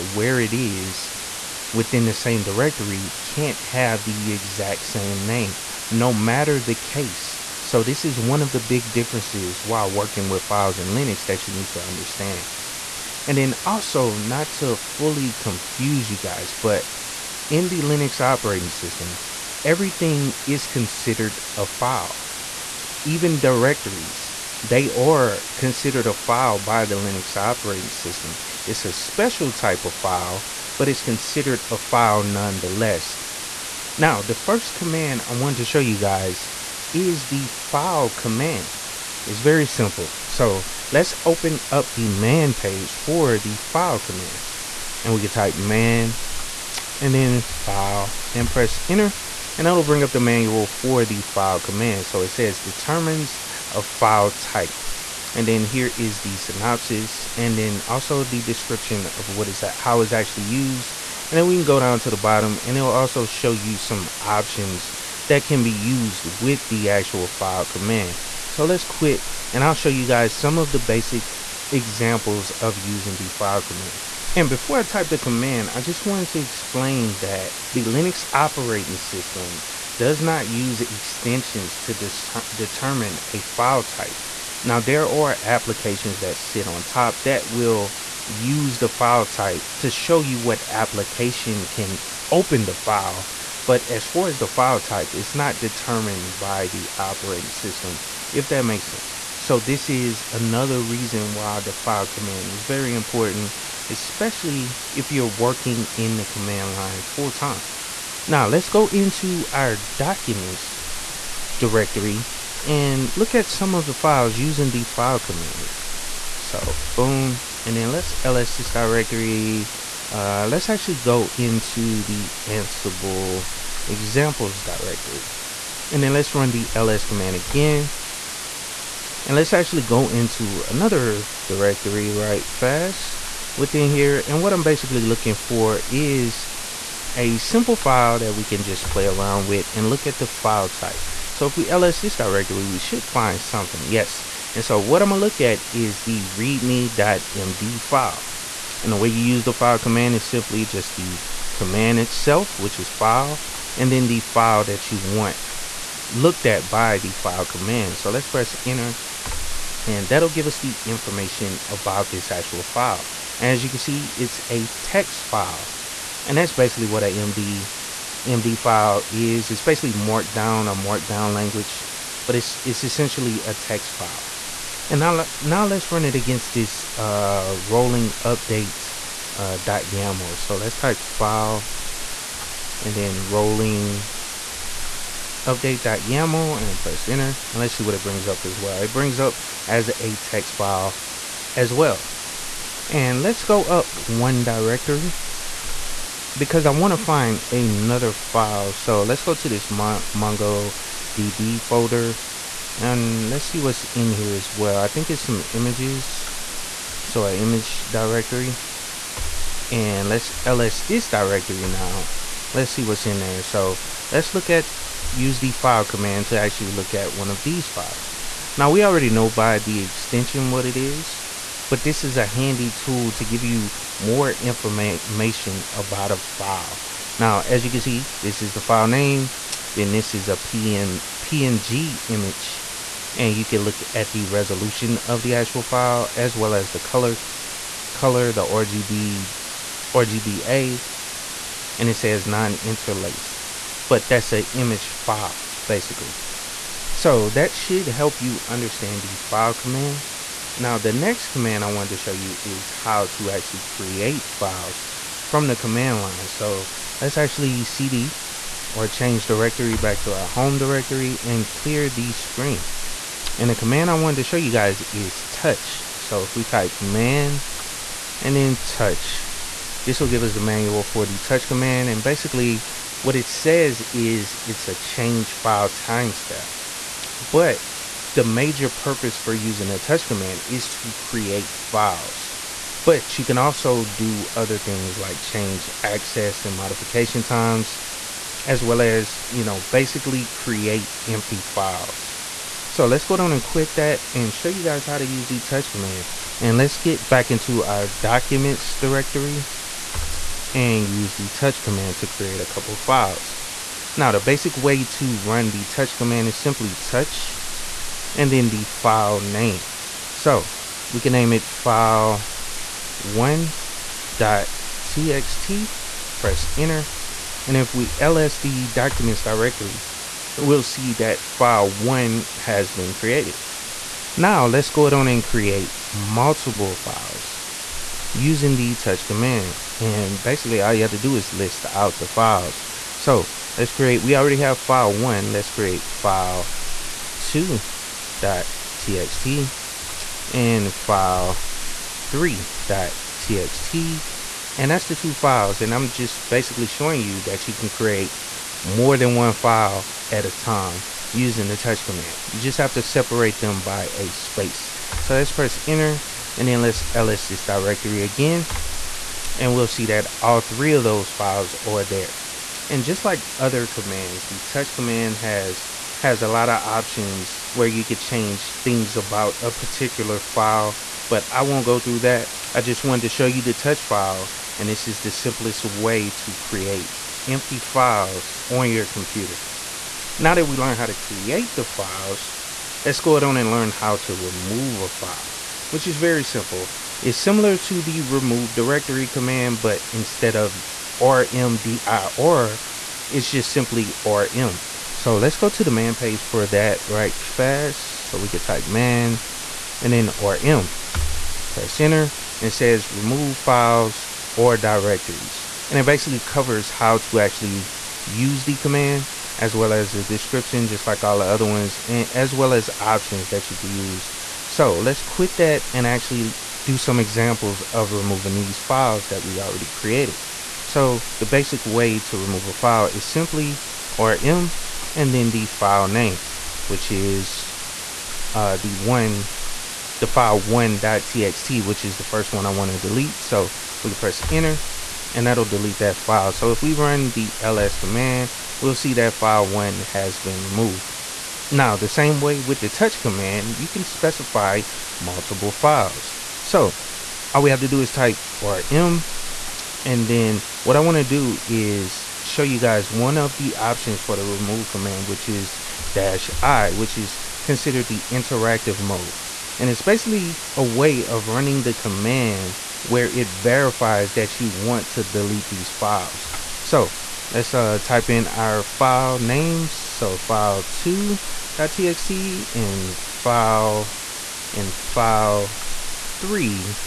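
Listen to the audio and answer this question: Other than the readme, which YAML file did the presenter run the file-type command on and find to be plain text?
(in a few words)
rolling update.yaml.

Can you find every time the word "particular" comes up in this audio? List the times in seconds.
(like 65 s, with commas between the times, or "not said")
369 s.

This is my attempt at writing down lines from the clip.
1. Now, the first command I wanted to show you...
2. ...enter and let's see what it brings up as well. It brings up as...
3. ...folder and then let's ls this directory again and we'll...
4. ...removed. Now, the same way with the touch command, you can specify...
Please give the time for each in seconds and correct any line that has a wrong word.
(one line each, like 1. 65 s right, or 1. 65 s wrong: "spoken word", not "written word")
1. 33 s right
2. 187 s right
3. 355 s wrong: "enter", not "folder"
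4. 440 s right.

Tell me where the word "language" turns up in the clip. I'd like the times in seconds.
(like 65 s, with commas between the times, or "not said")
171 s.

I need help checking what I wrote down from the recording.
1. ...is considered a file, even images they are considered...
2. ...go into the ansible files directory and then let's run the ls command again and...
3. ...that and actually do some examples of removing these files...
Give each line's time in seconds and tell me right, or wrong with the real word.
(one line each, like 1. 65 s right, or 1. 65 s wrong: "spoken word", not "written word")
1. 20 s wrong: "directories", not "images"
2. 120 s wrong: "examples", not "files"
3. 415 s right.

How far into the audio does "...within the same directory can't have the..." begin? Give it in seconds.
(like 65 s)
1 s.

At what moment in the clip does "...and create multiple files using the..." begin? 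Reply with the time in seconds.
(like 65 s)
325 s.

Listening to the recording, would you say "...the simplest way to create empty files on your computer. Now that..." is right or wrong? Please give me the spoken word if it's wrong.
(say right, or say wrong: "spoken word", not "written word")
right.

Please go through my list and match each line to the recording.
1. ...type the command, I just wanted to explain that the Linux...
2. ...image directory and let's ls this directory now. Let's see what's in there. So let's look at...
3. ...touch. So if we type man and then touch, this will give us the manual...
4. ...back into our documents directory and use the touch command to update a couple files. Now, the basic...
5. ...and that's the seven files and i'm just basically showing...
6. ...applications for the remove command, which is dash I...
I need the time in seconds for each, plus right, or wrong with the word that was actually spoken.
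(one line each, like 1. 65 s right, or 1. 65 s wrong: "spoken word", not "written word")
1. 74 s right
2. 207 s right
3. 265 s right
4. 297 s wrong: "create", not "update"
5. 344 s wrong: "two", not "seven"
6. 453 s wrong: "options", not "applications".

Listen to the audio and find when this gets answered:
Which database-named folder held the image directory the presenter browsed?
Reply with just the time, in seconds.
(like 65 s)
200 s.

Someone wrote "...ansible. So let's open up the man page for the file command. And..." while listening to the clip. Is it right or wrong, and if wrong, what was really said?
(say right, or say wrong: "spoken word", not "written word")
wrong: "simple", not "ansible".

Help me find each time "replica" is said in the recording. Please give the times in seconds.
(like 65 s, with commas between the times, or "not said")
not said.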